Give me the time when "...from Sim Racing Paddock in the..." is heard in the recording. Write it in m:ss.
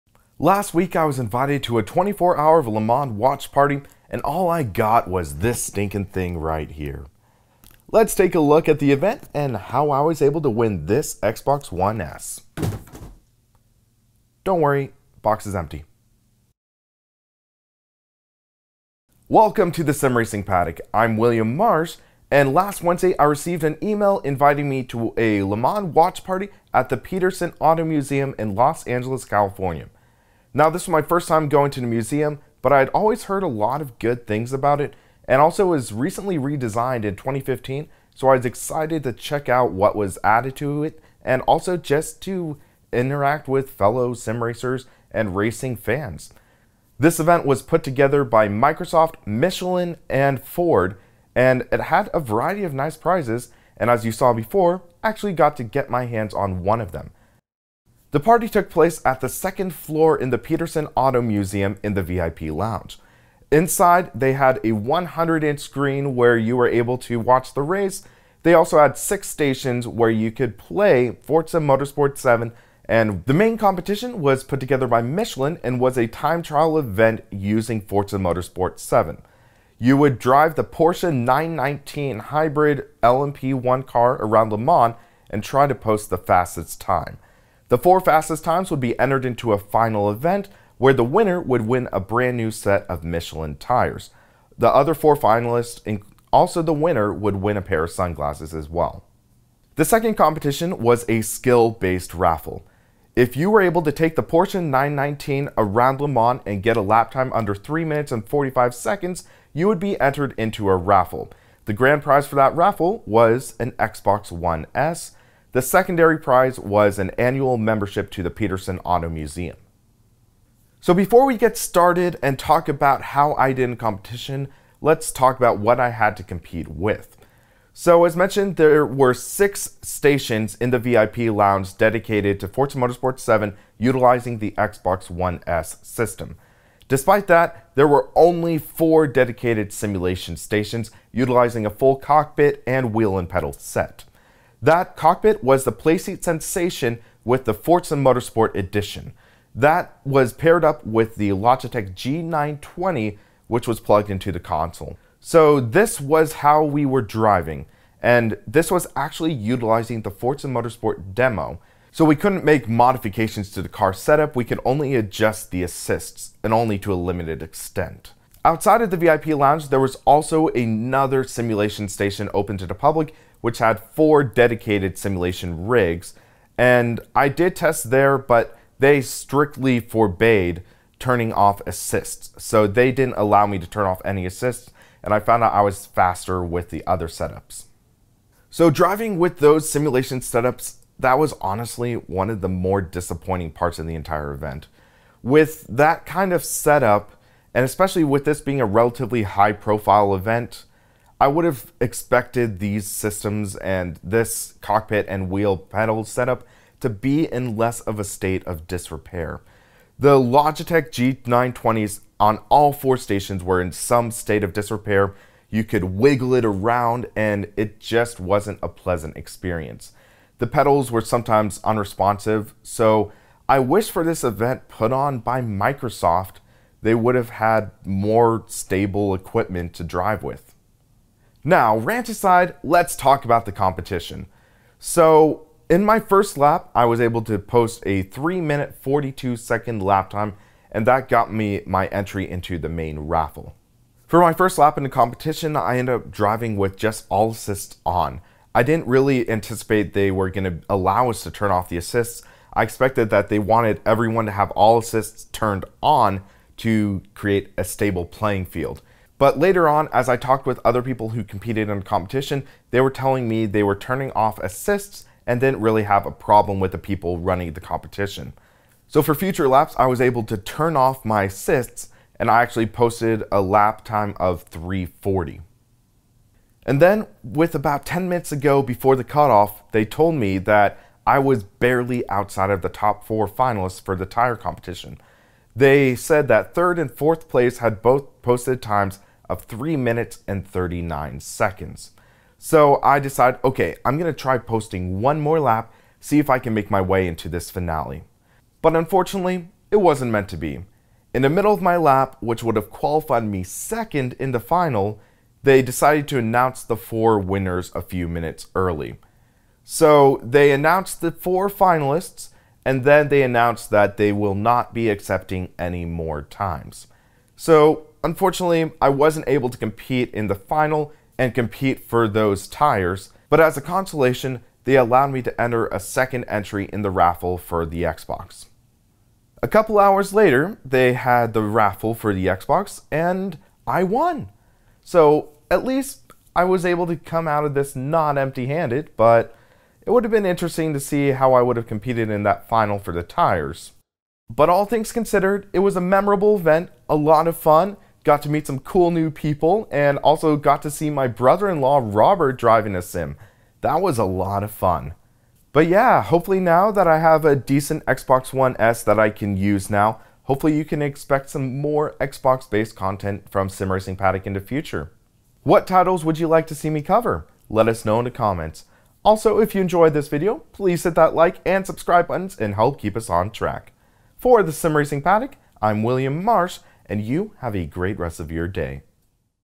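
6:03.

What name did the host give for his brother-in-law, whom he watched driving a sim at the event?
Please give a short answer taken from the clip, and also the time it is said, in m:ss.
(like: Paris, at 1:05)
Robert, at 5:51.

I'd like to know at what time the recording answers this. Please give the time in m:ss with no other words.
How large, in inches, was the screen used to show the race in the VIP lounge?
1:04.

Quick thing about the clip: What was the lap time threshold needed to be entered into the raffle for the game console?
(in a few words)
3 minutes 45 seconds.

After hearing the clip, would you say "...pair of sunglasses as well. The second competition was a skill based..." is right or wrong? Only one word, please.
right.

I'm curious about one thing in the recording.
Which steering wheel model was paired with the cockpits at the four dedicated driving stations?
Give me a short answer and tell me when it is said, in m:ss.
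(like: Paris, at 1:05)
Logitech G920, at 2:31.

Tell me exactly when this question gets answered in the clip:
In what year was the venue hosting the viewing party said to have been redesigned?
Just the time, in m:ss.
0:37.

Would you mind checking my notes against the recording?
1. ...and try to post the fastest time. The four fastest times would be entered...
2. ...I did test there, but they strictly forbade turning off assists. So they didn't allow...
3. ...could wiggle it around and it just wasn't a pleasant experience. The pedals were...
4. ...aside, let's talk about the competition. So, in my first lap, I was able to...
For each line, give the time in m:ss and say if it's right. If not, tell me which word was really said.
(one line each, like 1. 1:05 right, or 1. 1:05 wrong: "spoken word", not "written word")
1. 1:25 right
2. 2:57 right
3. 3:35 right
4. 3:52 right.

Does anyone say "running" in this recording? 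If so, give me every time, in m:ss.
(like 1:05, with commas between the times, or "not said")
4:27.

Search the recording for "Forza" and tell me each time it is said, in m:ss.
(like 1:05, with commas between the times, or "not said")
1:11, 1:17, 2:12, 2:27, 2:40.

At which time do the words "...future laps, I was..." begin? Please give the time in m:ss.
4:29.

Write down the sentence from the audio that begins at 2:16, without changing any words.
Despite that, there were only four dedicated simulation stations utilizing a full cockpit and wheel and pedal set.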